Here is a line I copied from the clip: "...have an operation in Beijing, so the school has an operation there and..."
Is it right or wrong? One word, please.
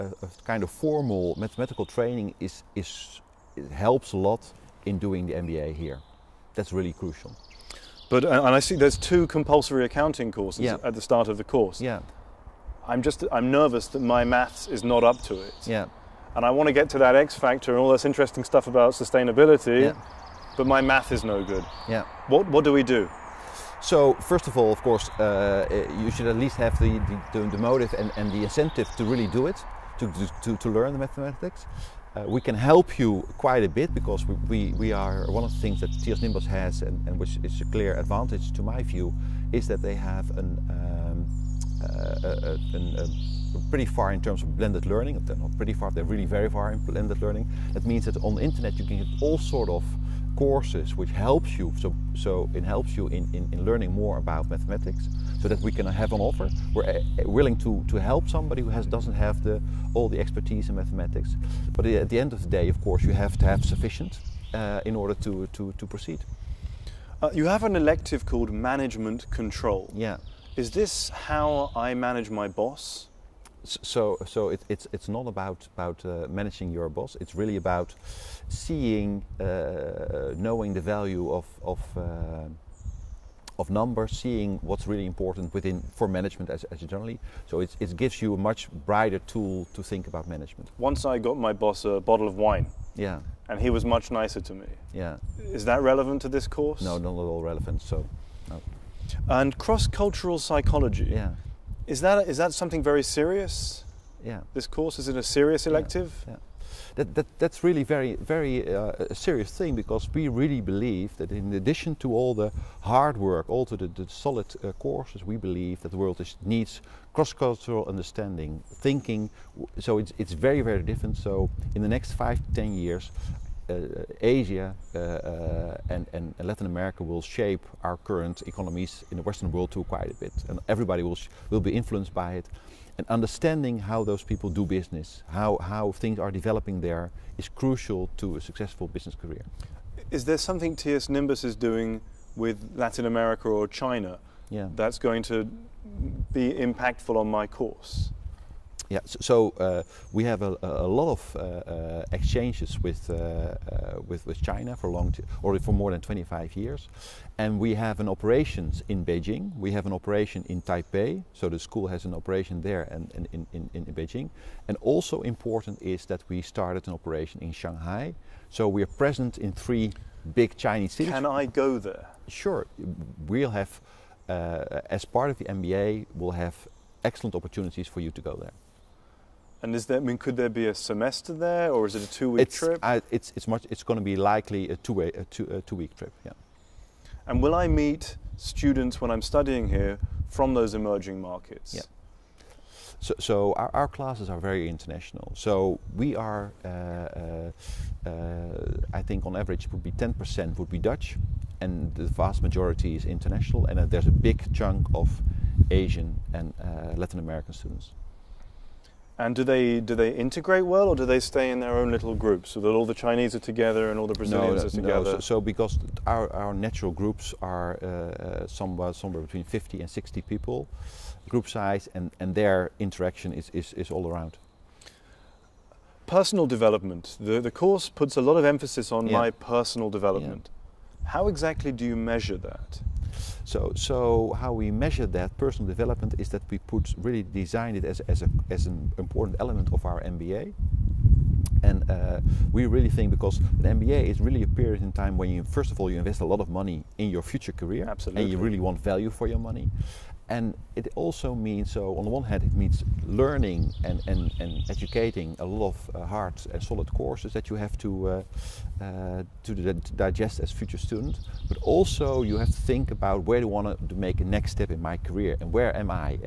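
wrong.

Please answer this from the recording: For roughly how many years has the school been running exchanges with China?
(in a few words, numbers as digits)
25 years.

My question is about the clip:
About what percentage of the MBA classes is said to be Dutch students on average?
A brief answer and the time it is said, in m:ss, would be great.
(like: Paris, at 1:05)
10%, at 3:19.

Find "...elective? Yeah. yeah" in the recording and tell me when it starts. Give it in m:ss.
1:45.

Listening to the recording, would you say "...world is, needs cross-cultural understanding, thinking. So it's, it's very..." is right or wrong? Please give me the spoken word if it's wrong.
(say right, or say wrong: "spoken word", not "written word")
right.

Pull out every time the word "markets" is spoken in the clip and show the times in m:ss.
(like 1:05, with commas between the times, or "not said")
3:11.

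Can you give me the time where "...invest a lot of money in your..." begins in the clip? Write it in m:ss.
4:05.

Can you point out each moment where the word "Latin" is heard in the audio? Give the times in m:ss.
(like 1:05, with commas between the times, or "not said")
2:06, 2:22, 3:26.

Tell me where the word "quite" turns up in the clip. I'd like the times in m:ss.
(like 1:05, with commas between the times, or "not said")
0:33, 2:09.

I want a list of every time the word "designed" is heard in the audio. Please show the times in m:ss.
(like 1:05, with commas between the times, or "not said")
3:57.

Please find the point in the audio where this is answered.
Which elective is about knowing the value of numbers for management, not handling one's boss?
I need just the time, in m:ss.
1:08.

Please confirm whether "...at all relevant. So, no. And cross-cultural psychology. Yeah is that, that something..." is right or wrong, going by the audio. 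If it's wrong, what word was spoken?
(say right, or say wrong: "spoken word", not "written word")
right.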